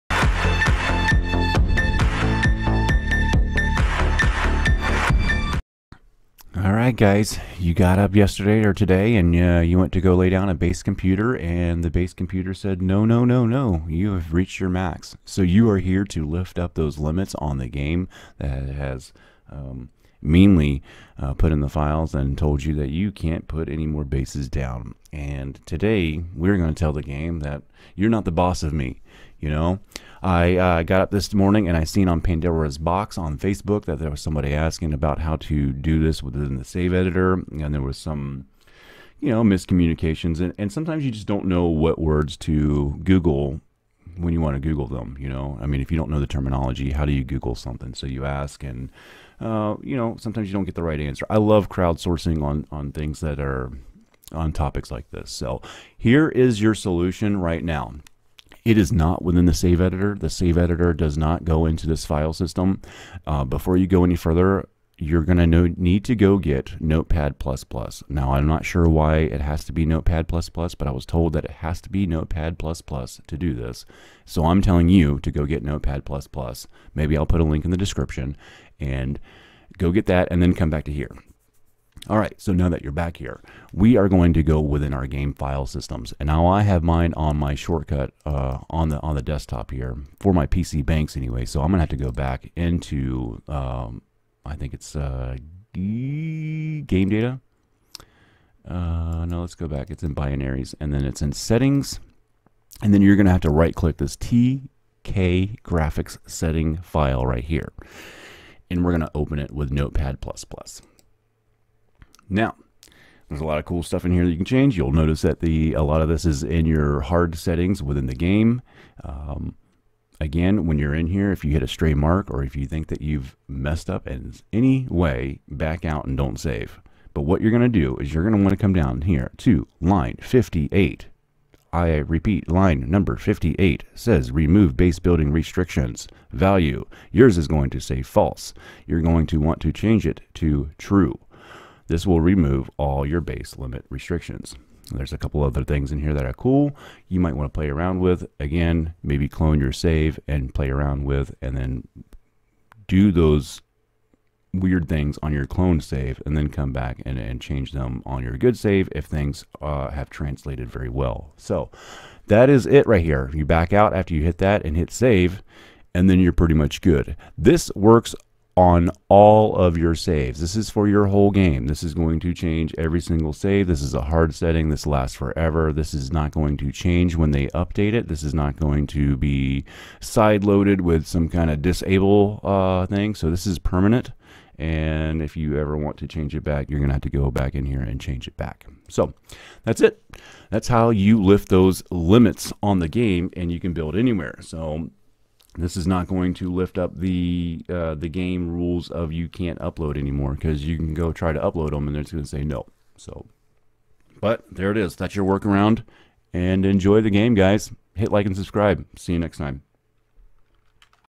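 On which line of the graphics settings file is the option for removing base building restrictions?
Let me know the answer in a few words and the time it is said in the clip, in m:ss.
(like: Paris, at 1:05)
58, at 2:12.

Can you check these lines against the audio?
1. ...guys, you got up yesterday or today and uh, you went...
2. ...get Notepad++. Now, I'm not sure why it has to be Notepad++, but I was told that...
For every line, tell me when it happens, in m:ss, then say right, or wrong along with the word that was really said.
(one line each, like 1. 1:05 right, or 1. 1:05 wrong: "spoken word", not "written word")
1. 0:06 right
2. 1:06 right.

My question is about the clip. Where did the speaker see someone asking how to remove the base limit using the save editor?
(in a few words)
Pandora's box on Facebook.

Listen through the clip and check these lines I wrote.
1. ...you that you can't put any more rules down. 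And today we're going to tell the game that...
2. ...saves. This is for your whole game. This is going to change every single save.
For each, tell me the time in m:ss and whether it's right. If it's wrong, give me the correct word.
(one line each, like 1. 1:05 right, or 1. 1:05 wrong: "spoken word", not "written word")
1. 0:22 wrong: "bases", not "rules"
2. 2:49 right.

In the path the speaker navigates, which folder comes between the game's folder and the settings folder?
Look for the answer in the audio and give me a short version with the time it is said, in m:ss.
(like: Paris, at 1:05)
binaries, at 1:40.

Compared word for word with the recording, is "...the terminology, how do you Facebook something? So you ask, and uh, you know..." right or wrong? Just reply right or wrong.
wrong.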